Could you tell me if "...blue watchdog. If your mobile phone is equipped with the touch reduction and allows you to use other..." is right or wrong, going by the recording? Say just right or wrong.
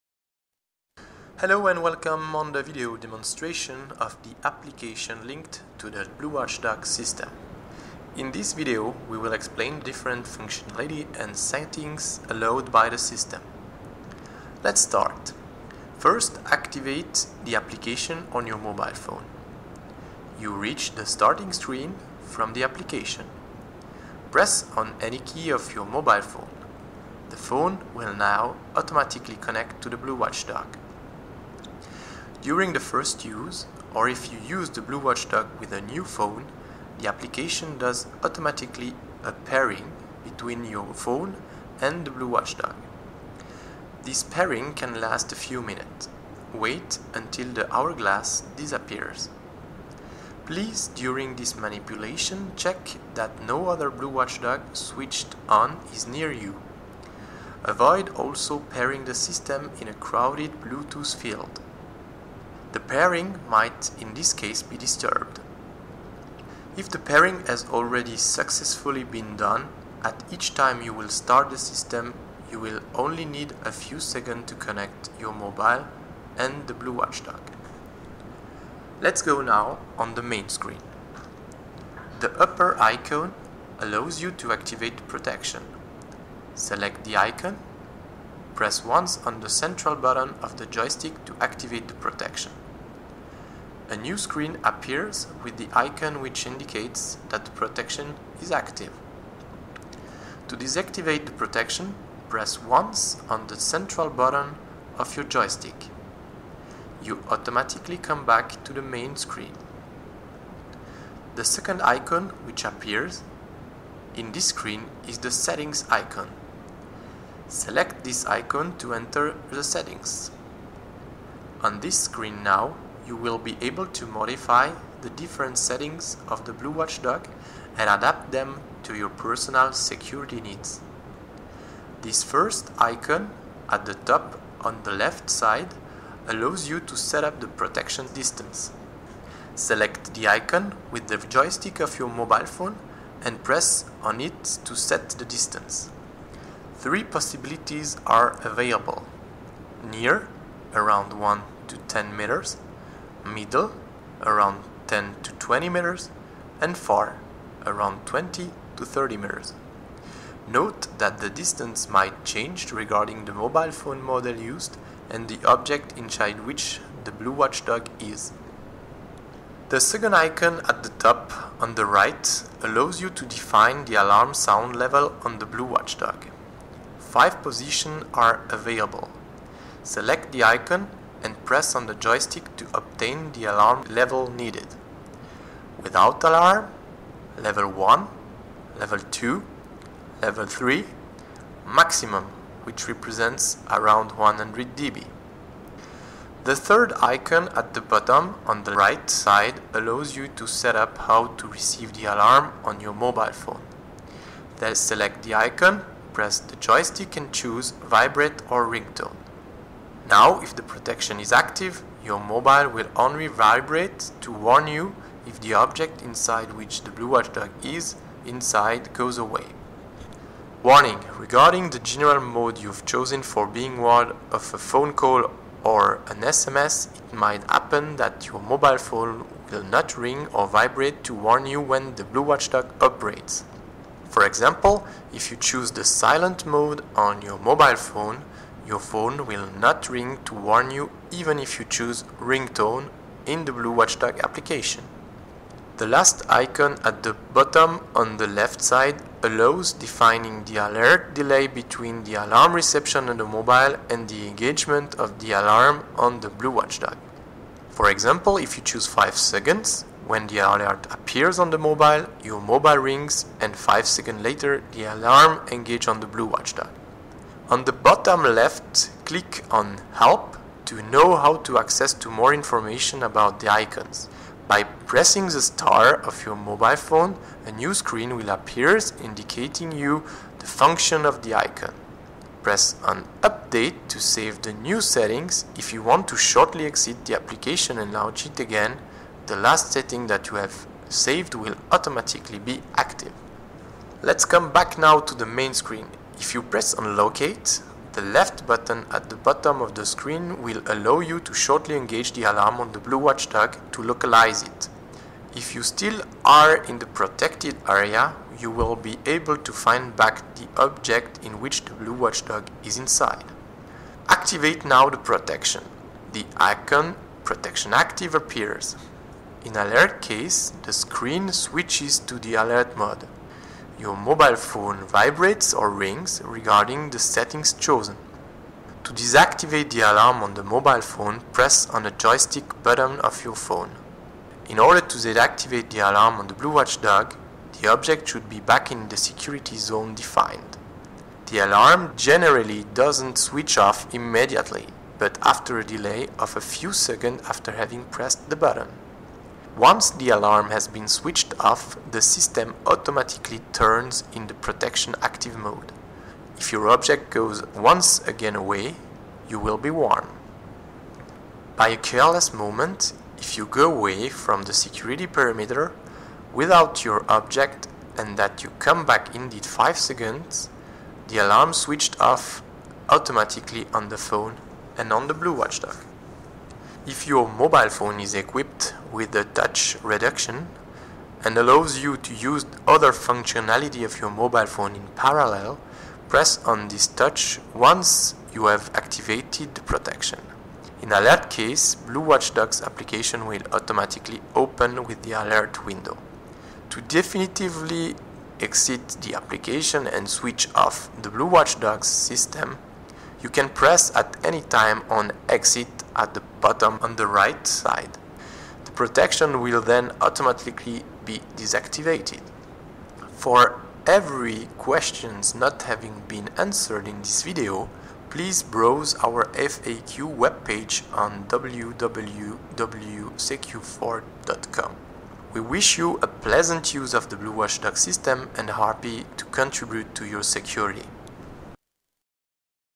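right.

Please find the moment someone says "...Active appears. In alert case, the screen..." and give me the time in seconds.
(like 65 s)
317 s.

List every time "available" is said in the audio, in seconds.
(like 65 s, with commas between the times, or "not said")
148 s, 178 s.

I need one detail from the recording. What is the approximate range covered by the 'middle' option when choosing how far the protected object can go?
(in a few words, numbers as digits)
10 to 20 meters.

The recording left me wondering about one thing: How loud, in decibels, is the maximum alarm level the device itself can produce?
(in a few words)
100 dB.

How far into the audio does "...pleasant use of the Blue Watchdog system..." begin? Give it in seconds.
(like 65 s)
426 s.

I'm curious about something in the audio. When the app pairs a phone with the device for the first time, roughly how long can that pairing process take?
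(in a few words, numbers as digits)
a few minutes.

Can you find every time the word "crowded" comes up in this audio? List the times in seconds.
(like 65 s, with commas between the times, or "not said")
59 s.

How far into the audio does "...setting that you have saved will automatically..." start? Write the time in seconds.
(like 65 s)
289 s.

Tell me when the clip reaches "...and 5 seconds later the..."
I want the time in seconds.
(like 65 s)
263 s.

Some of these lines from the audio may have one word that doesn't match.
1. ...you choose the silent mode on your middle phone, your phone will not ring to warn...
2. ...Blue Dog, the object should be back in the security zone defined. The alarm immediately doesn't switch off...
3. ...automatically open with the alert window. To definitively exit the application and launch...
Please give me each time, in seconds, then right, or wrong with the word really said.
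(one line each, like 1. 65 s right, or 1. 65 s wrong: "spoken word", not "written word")
1. 235 s wrong: "mobile", not "middle"
2. 336 s wrong: "generally", not "immediately"
3. 393 s wrong: "switch", not "launch".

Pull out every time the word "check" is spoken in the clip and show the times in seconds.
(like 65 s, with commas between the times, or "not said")
52 s.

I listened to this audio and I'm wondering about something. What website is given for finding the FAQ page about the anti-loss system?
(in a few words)
www.secu4.com.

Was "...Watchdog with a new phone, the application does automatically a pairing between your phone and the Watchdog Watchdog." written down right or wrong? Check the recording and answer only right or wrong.
wrong.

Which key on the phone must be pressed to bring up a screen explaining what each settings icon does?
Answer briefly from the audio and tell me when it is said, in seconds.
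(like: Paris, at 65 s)
the star, at 275 s.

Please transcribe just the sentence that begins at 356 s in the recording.
If your object goes once again away, you will be warned.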